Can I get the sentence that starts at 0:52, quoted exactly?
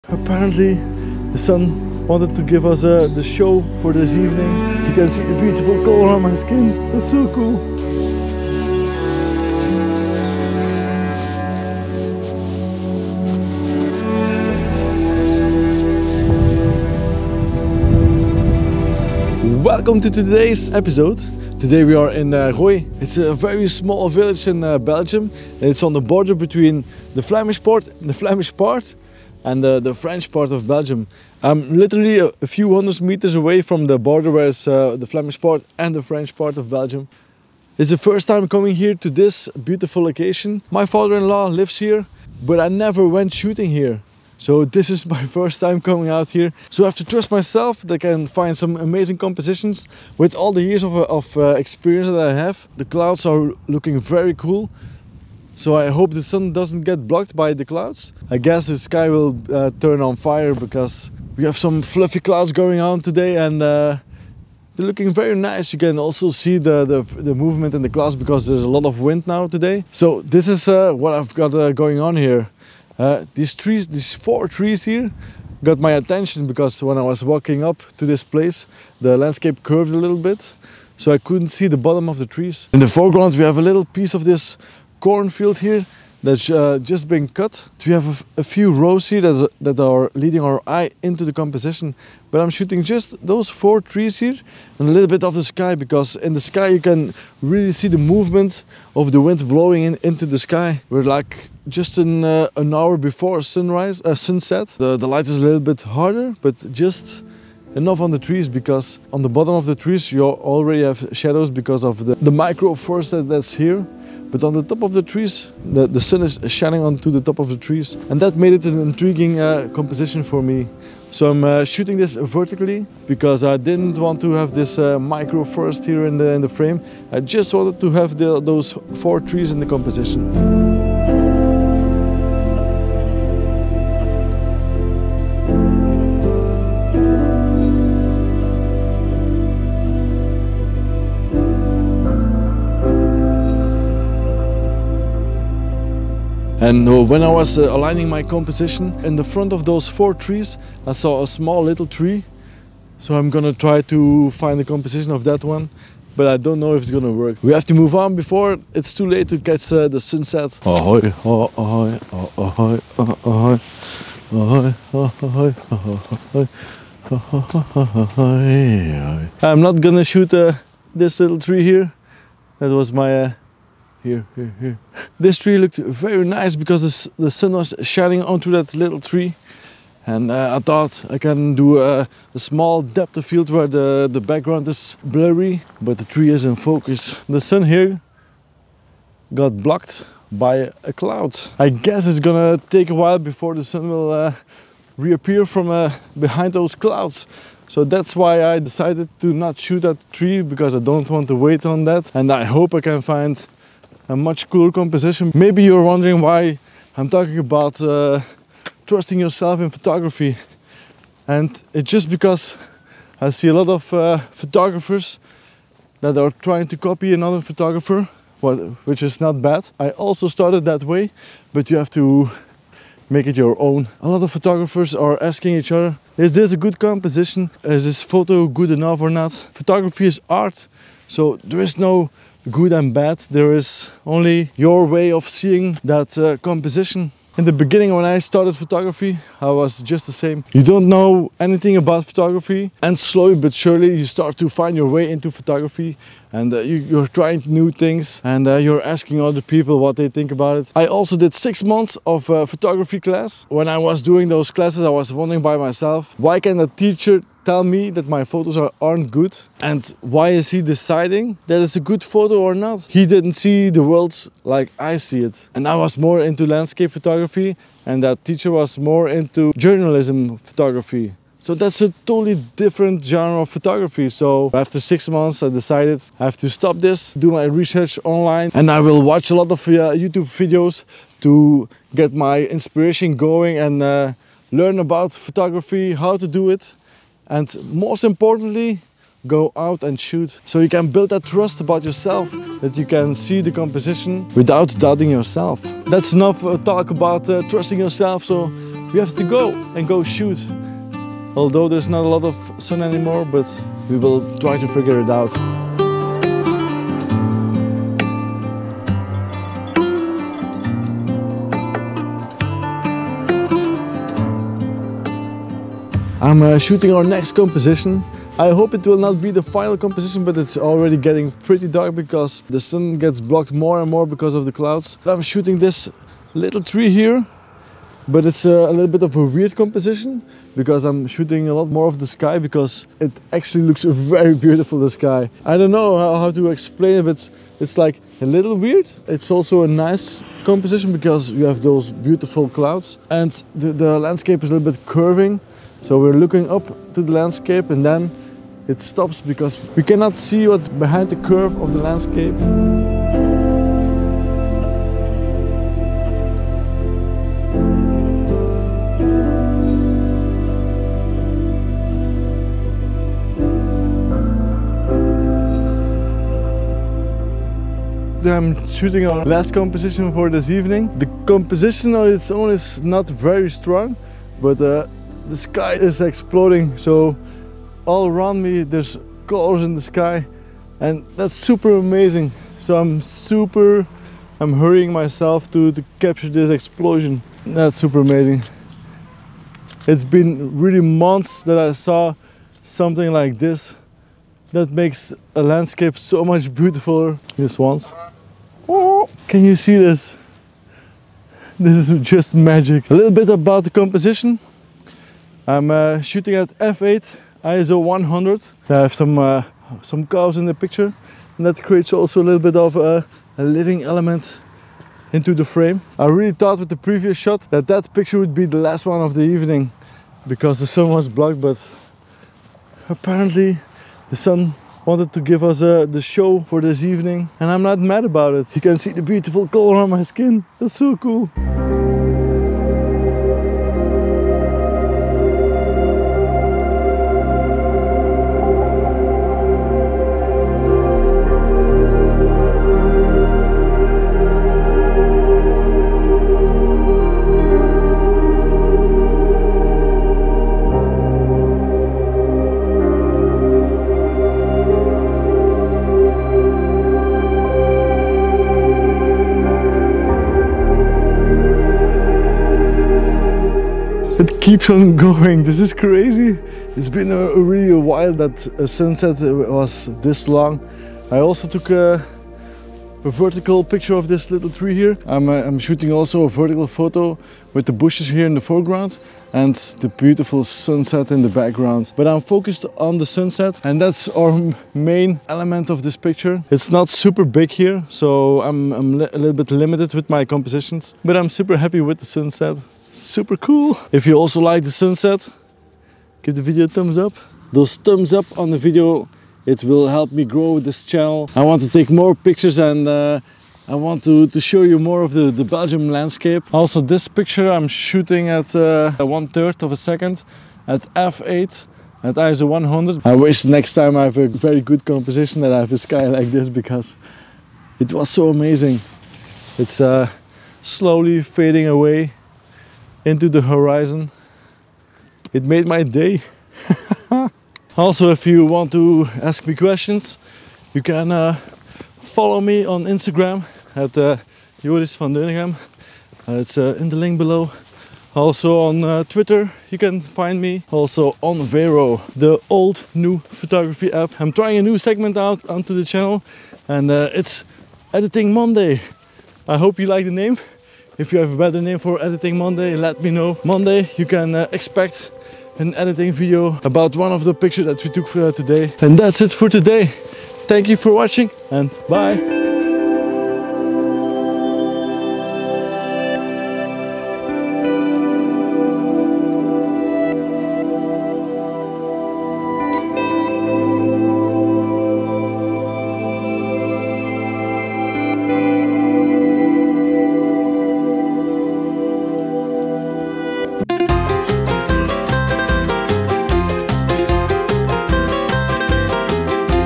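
The clouds are looking very cool.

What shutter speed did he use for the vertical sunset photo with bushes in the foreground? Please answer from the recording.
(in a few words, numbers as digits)
1/3 second.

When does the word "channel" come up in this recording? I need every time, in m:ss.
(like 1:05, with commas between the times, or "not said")
8:20, 9:05.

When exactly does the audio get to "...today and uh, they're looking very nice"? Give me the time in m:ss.
1:03.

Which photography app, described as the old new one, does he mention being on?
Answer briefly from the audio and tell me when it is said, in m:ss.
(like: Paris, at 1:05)
Vero, at 9:01.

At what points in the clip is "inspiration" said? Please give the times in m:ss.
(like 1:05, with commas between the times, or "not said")
4:42.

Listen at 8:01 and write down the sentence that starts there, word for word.
But I'm focused on the sunset and that's our main element of this picture.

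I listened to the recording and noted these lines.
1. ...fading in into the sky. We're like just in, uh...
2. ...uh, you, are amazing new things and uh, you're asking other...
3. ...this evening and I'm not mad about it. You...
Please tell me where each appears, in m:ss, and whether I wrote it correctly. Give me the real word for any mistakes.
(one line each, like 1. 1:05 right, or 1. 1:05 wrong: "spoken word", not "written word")
1. 1:39 wrong: "blowing", not "fading"
2. 4:06 wrong: "trying", not "amazing"
3. 7:06 right.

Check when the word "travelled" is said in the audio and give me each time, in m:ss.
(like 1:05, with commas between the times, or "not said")
not said.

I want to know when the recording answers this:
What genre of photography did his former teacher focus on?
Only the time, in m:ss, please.
4:29.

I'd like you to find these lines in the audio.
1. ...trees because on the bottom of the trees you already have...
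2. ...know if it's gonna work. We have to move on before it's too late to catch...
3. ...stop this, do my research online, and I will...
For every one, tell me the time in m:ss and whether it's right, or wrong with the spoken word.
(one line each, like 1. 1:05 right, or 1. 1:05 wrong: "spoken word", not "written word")
1. 1:48 right
2. 2:36 right
3. 4:36 right.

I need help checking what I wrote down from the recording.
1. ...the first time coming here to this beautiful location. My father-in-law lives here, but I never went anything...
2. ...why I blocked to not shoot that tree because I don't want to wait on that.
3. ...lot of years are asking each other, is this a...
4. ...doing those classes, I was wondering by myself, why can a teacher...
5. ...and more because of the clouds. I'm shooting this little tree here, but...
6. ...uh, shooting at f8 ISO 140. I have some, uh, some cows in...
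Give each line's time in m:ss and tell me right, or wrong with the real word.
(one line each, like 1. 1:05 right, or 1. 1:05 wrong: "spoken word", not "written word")
1. 0:37 wrong: "shooting", not "anything"
2. 3:18 wrong: "decided", not "blocked"
3. 3:44 wrong: "photographers", not "years"
4. 4:14 right
5. 5:23 right
6. 6:45 wrong: "100", not "140".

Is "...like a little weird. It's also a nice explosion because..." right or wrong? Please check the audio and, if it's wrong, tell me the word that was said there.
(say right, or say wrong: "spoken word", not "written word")
wrong: "composition", not "explosion".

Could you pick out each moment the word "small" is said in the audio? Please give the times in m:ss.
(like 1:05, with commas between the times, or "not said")
0:23, 2:31, 3:02.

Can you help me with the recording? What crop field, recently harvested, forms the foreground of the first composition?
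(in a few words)
Cornfield.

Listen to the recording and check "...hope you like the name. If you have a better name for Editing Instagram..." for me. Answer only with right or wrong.
wrong.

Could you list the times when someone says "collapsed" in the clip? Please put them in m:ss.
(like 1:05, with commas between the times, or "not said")
not said.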